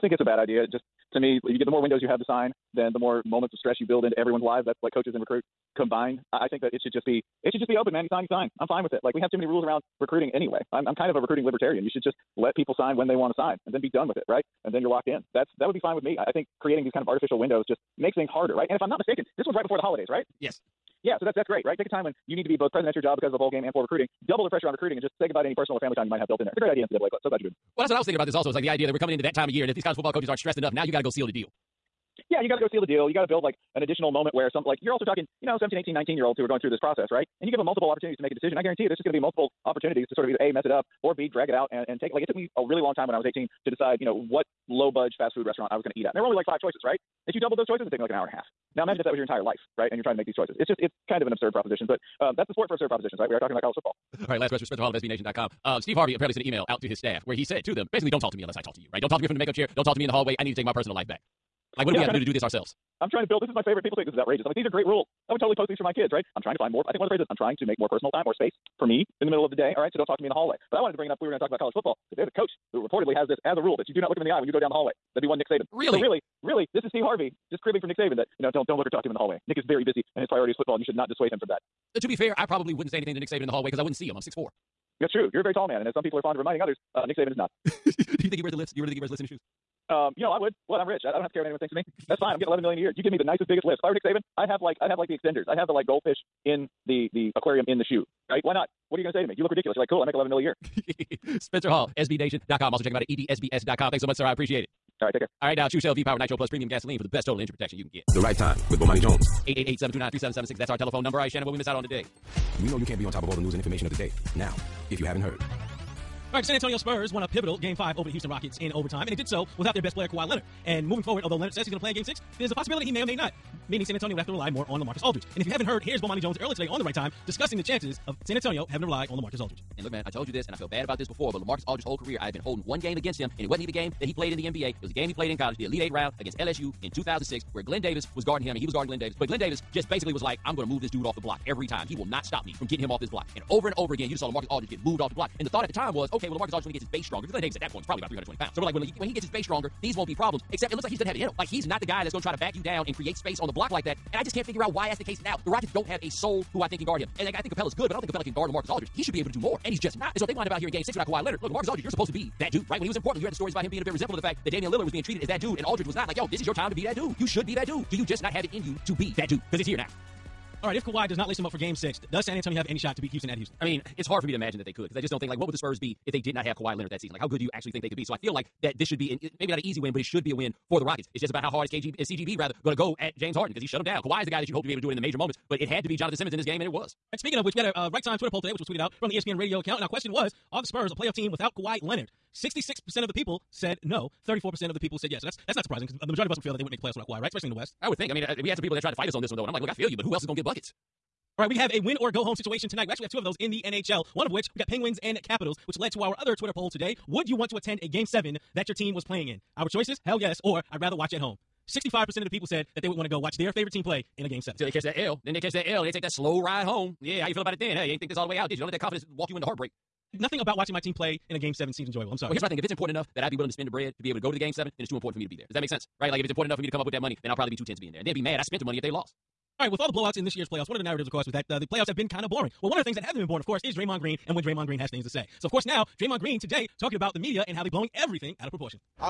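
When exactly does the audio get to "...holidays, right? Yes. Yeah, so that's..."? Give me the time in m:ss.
0:19.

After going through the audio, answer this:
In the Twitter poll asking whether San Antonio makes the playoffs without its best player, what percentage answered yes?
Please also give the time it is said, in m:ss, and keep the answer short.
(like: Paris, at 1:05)
34%, at 3:14.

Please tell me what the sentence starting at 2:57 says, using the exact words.
Like, how good do you actually think they could be?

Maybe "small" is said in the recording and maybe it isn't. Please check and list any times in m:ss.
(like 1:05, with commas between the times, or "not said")
not said.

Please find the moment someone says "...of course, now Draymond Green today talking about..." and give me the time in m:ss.
3:55.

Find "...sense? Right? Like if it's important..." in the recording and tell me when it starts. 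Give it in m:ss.
3:45.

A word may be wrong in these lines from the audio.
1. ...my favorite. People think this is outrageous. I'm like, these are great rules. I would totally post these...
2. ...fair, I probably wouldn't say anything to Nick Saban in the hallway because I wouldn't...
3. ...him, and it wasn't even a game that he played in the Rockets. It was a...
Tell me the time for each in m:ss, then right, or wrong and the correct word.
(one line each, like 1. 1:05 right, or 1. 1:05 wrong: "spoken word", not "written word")
1. 1:03 right
2. 1:22 right
3. 2:13 wrong: "NBA", not "Rockets".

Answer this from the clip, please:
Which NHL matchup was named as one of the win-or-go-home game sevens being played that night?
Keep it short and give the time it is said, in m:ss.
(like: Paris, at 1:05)
Penguins and Capitals, at 3:24.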